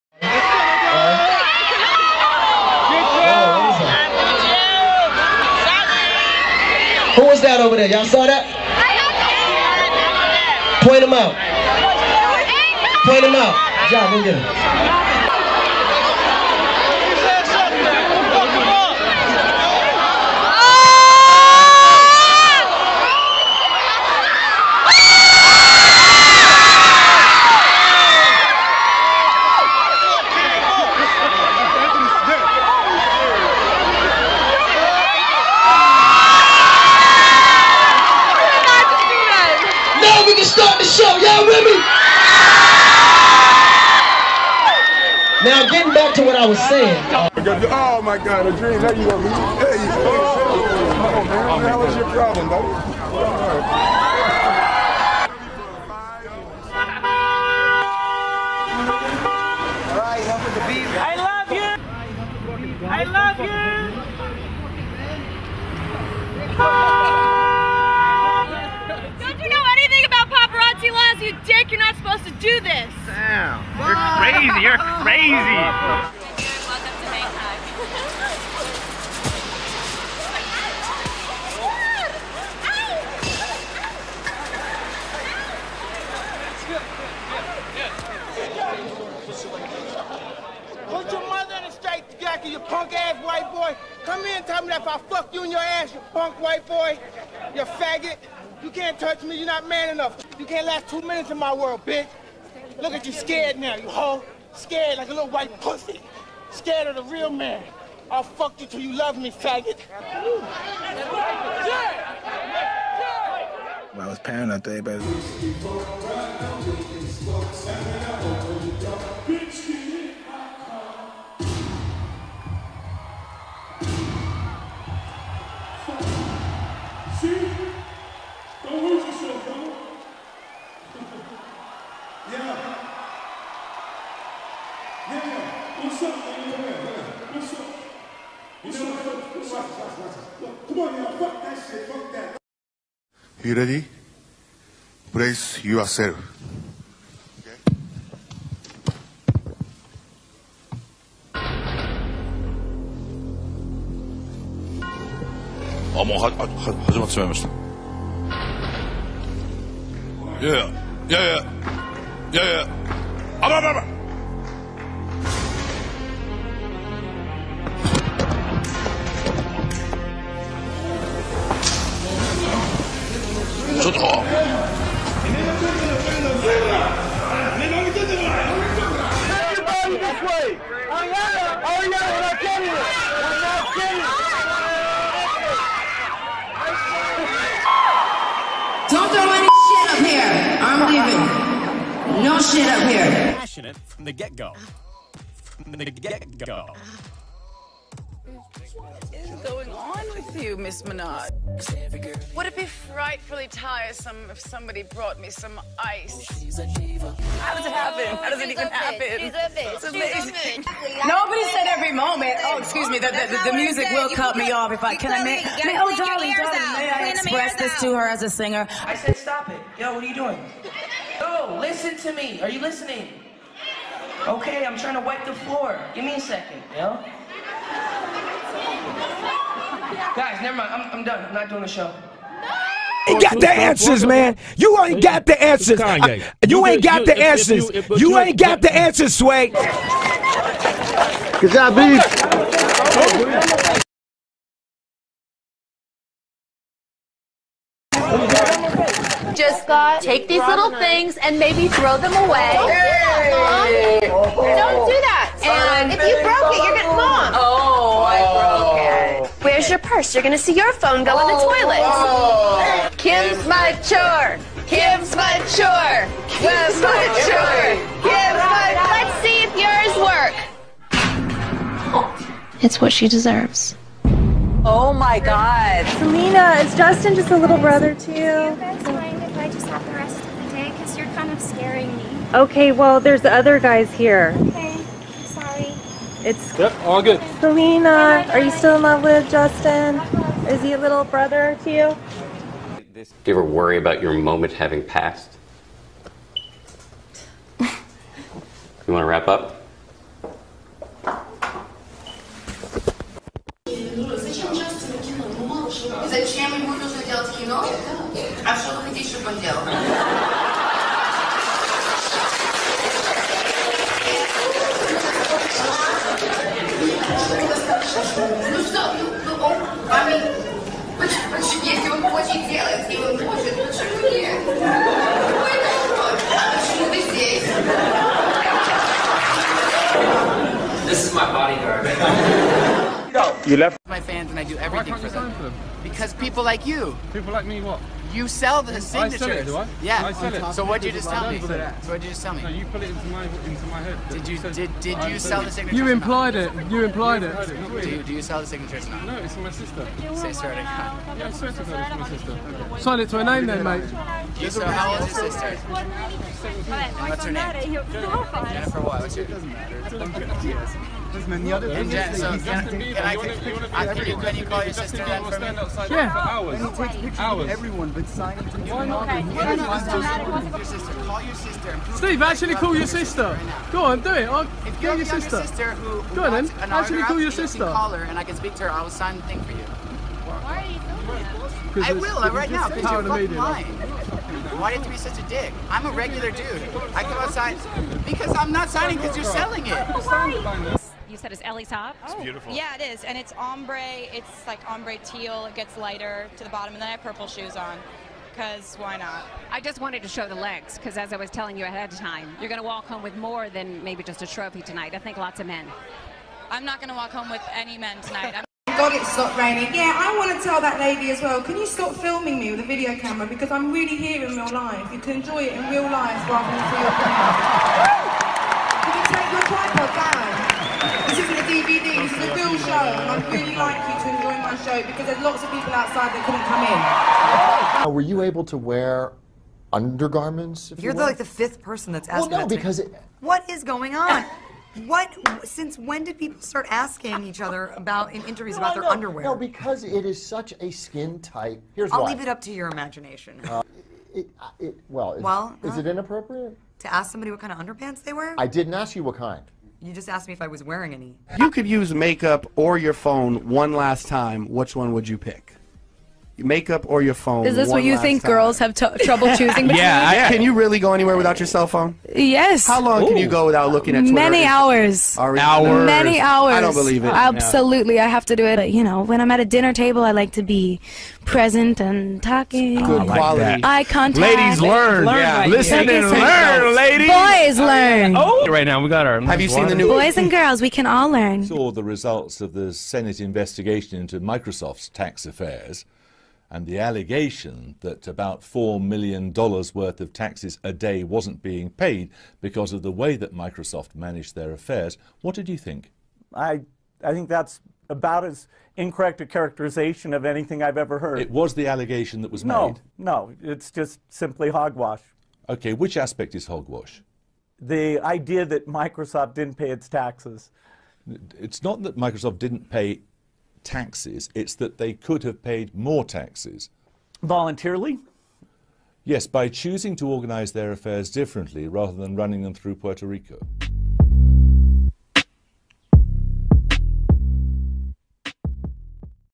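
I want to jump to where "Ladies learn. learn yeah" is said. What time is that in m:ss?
7:54.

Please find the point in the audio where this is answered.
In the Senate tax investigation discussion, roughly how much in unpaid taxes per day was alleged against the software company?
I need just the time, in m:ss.
8:08.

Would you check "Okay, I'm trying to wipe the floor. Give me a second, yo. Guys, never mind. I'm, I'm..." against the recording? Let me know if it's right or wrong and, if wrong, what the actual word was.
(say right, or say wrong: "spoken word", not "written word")
right.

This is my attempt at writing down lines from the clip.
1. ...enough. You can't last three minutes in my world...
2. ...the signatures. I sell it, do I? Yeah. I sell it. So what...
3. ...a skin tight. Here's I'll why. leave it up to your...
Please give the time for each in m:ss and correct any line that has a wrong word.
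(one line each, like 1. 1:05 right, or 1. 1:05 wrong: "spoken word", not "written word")
1. 1:39 wrong: "two", not "three"
2. 5:38 right
3. 7:20 right.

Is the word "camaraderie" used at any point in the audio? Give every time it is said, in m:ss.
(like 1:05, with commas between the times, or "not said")
not said.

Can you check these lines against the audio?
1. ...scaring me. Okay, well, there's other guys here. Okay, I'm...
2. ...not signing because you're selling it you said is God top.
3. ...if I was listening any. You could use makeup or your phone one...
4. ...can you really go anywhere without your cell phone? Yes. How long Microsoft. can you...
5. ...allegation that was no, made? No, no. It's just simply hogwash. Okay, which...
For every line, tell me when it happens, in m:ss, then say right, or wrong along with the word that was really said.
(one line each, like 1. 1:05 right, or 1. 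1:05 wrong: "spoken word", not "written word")
1. 4:41 right
2. 6:28 wrong: "Ellie", not "God"
3. 7:30 wrong: "wearing", not "listening"
4. 7:40 wrong: "Ooh", not "Microsoft"
5. 8:21 right.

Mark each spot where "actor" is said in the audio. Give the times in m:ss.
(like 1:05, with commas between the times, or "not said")
not said.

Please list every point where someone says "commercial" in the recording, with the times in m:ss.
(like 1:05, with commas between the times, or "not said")
not said.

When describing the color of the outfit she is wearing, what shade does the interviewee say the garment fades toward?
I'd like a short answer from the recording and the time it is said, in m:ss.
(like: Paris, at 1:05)
Ombre teal, at 6:34.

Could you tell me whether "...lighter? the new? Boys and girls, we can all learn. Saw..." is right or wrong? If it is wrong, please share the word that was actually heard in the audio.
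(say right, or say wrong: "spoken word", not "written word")
wrong: "water", not "lighter".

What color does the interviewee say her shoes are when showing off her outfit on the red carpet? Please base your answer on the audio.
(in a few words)
Purple.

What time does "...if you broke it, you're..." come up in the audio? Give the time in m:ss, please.
4:15.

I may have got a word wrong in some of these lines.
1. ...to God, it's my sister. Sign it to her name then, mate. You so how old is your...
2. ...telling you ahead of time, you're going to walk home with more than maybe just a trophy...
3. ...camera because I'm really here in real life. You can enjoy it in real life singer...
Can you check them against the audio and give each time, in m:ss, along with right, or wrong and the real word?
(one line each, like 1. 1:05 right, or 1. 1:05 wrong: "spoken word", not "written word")
1. 5:51 right
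2. 6:41 right
3. 6:52 wrong: "rather", not "singer".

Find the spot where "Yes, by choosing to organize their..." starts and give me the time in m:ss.
8:39.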